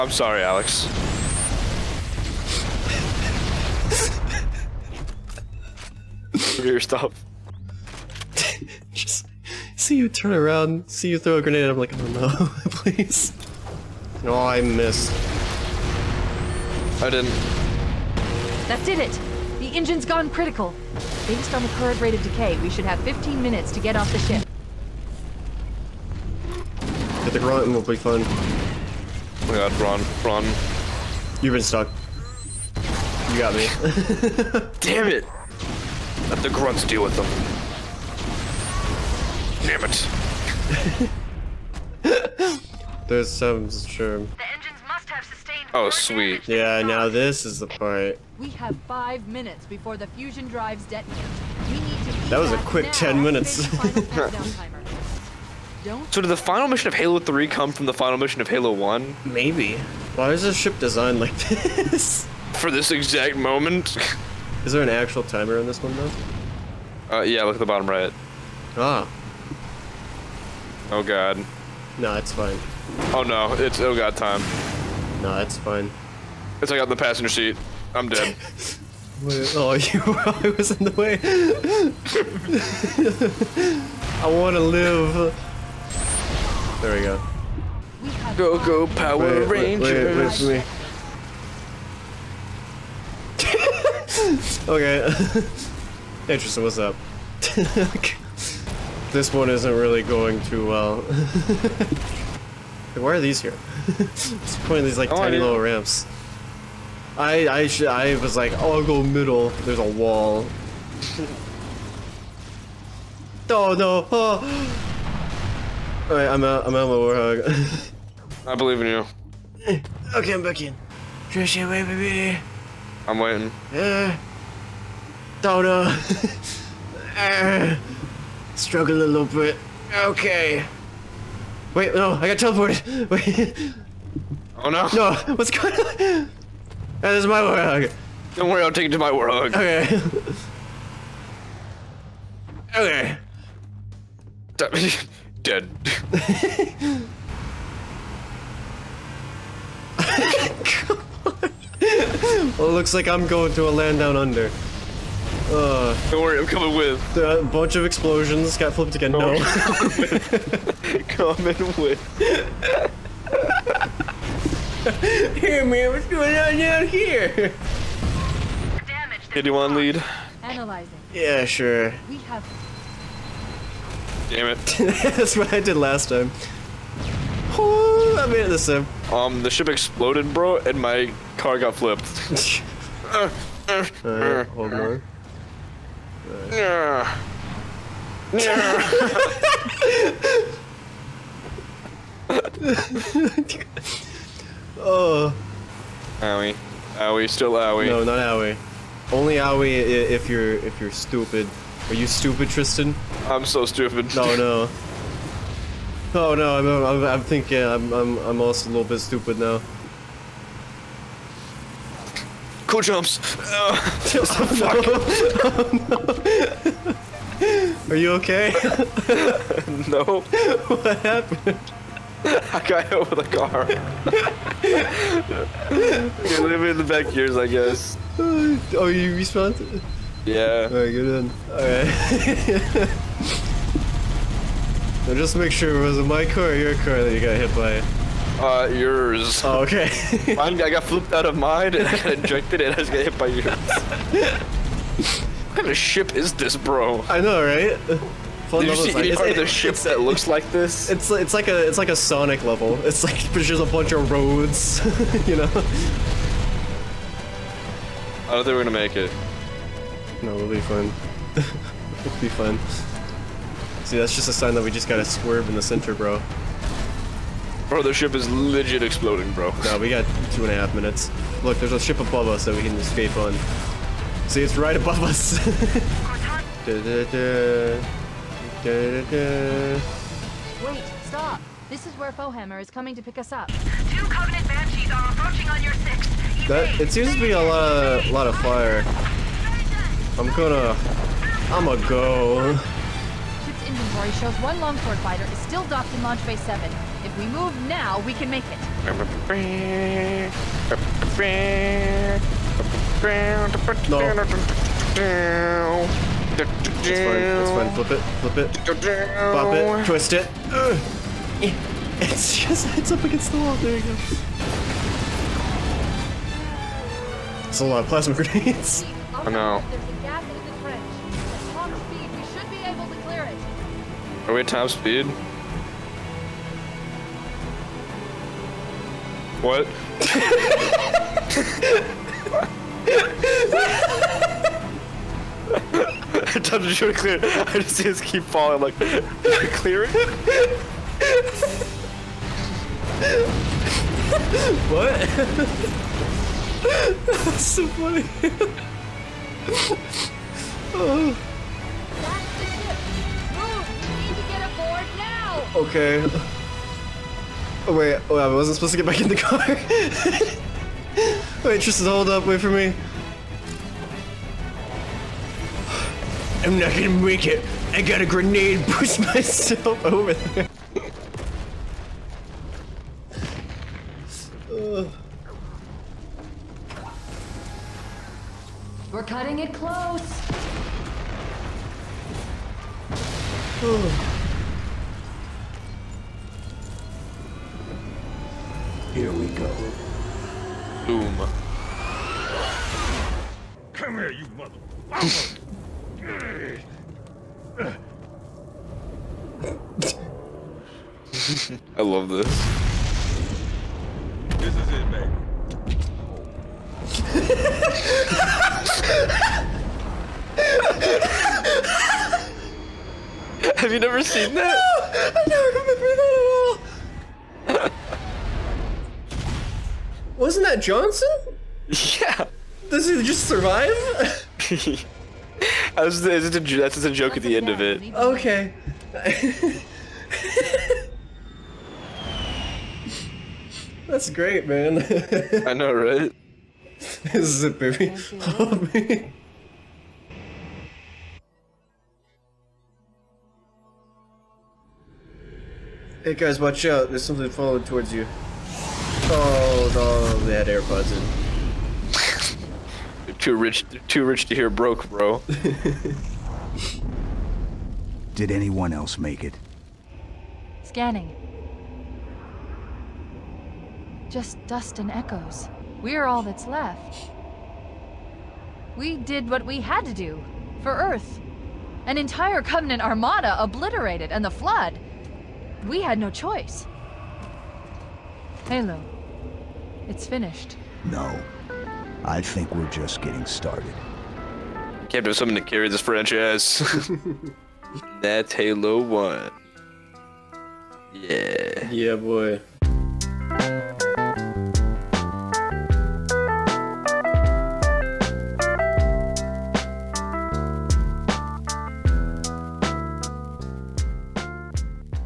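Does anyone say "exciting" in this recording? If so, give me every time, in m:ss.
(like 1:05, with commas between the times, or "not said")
not said.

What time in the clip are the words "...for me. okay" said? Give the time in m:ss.
1:34.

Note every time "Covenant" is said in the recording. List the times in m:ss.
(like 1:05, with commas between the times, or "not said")
4:44, 7:52.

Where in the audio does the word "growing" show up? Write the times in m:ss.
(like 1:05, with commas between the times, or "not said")
not said.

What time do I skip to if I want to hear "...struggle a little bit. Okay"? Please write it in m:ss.
2:08.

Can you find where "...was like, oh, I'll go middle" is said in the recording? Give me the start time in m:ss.
1:48.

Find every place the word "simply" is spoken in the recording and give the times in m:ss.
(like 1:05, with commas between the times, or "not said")
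not said.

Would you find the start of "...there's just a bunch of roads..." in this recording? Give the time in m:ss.
4:13.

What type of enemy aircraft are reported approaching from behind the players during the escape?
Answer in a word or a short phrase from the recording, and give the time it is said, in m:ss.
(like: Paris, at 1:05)
Banshees, at 4:44.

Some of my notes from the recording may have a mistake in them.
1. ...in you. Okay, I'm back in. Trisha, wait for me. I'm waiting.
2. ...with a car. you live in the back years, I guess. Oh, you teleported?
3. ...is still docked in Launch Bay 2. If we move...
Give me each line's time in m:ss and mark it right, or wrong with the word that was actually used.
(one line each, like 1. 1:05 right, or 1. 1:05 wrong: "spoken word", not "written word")
1. 1:58 right
2. 3:43 wrong: "respawned", not "teleported"
3. 4:55 wrong: "7", not "2".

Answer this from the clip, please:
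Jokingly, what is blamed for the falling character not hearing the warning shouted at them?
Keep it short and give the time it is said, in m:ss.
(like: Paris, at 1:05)
AirPods, at 7:30.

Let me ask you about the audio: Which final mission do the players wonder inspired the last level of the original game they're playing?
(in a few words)
Halo 3.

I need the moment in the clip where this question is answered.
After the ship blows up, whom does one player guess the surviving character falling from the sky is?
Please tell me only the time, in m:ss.
7:00.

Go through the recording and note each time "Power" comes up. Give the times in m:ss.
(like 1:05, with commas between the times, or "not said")
1:28.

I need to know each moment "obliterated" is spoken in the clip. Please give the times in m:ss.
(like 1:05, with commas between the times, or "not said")
7:53.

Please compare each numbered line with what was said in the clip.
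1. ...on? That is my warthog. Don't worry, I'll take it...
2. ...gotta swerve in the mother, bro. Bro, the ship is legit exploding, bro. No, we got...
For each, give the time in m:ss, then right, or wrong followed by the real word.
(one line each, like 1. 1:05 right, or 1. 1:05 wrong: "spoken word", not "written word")
1. 2:15 right
2. 4:24 wrong: "center", not "mother".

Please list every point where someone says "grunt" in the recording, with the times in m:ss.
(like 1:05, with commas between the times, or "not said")
0:27, 0:36.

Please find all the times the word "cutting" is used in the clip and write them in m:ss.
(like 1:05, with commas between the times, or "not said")
6:19.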